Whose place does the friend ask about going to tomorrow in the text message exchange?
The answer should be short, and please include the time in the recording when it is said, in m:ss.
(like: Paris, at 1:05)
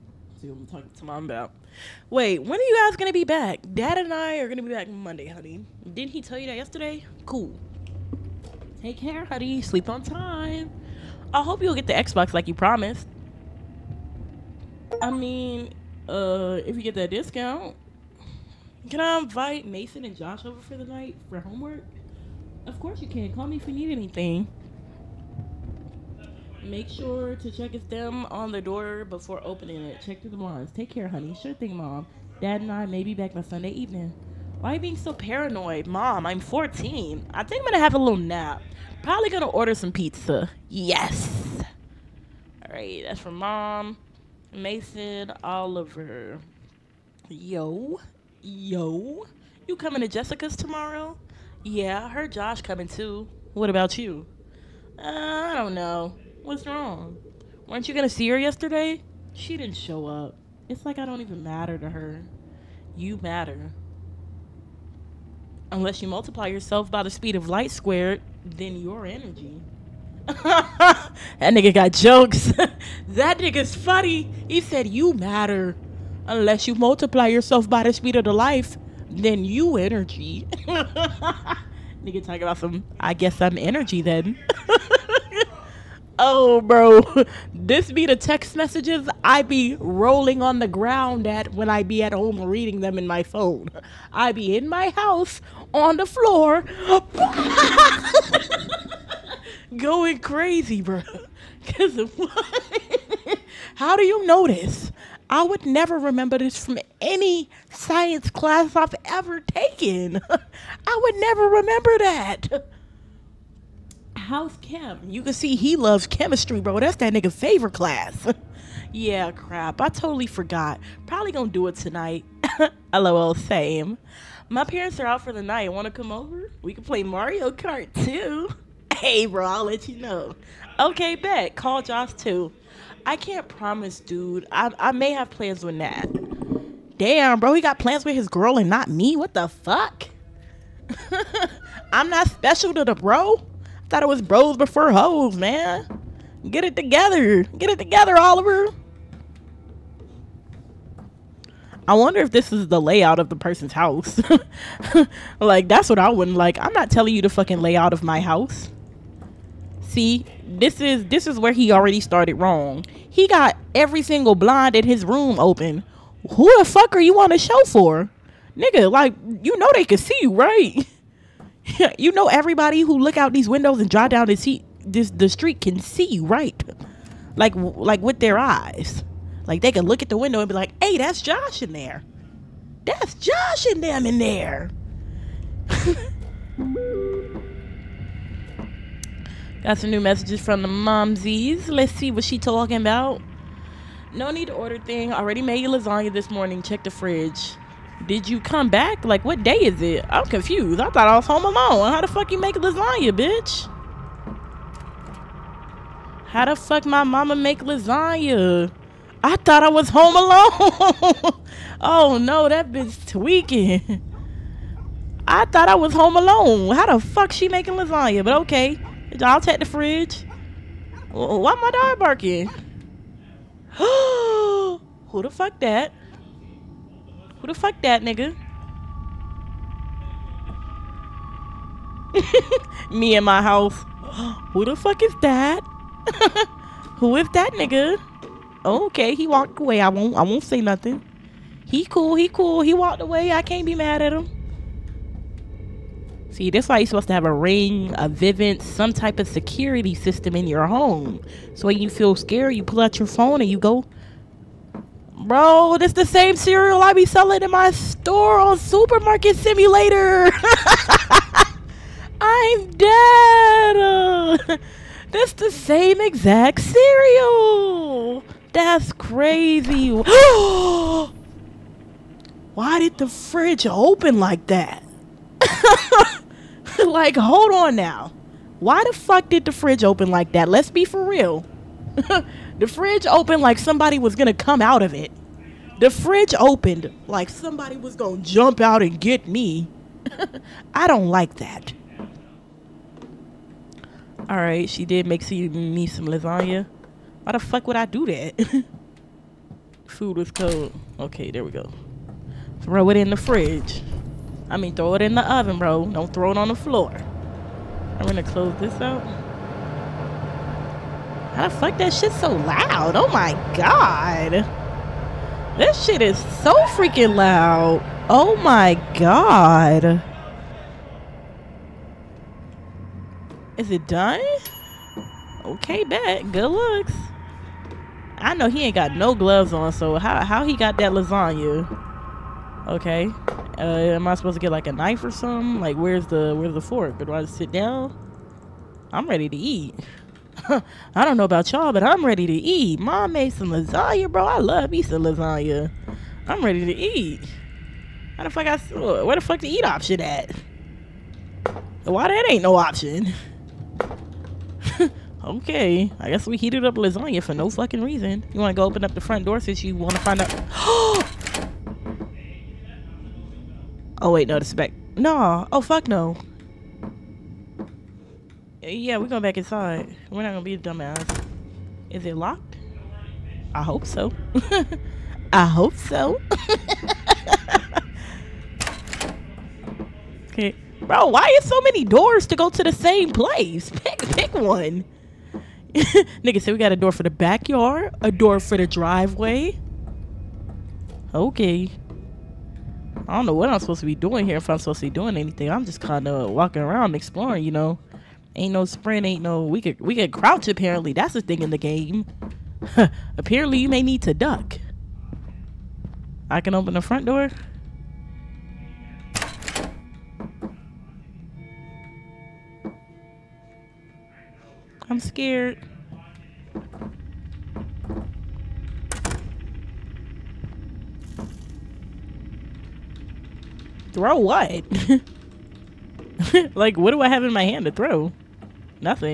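Jessica's, at 0:50.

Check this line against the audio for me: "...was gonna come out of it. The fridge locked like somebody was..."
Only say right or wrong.
wrong.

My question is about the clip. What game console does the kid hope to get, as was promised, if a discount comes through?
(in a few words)
Xbox.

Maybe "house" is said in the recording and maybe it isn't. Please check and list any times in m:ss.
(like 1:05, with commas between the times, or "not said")
1:34, 2:33, 2:38, 3:53.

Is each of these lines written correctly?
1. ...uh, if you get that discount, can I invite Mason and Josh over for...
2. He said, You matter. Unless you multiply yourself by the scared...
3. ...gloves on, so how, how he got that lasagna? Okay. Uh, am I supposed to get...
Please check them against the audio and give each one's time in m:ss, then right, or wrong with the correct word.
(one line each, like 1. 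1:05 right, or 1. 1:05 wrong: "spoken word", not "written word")
1. 0:16 right
2. 1:14 wrong: "speed", not "scared"
3. 5:29 right.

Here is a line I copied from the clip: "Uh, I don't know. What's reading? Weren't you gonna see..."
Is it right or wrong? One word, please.
wrong.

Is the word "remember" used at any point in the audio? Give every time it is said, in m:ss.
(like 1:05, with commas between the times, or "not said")
1:45, 1:51.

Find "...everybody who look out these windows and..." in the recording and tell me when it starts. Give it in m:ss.
2:52.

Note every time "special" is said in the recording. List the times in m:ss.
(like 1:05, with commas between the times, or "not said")
2:22.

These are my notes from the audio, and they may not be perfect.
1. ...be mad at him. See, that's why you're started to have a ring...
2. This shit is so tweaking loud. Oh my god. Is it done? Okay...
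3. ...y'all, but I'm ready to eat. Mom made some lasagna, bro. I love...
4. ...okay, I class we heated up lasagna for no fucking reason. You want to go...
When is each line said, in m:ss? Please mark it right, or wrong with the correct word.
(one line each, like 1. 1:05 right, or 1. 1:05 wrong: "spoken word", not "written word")
1. 4:03 wrong: "supposed", not "started"
2. 5:15 wrong: "freaking", not "tweaking"
3. 5:41 right
4. 5:55 wrong: "guess", not "class".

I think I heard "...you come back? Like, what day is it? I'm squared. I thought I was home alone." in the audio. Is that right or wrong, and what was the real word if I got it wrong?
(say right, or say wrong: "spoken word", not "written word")
wrong: "confused", not "squared".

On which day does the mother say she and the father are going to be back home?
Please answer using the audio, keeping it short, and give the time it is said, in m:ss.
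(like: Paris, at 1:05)
Monday, at 0:04.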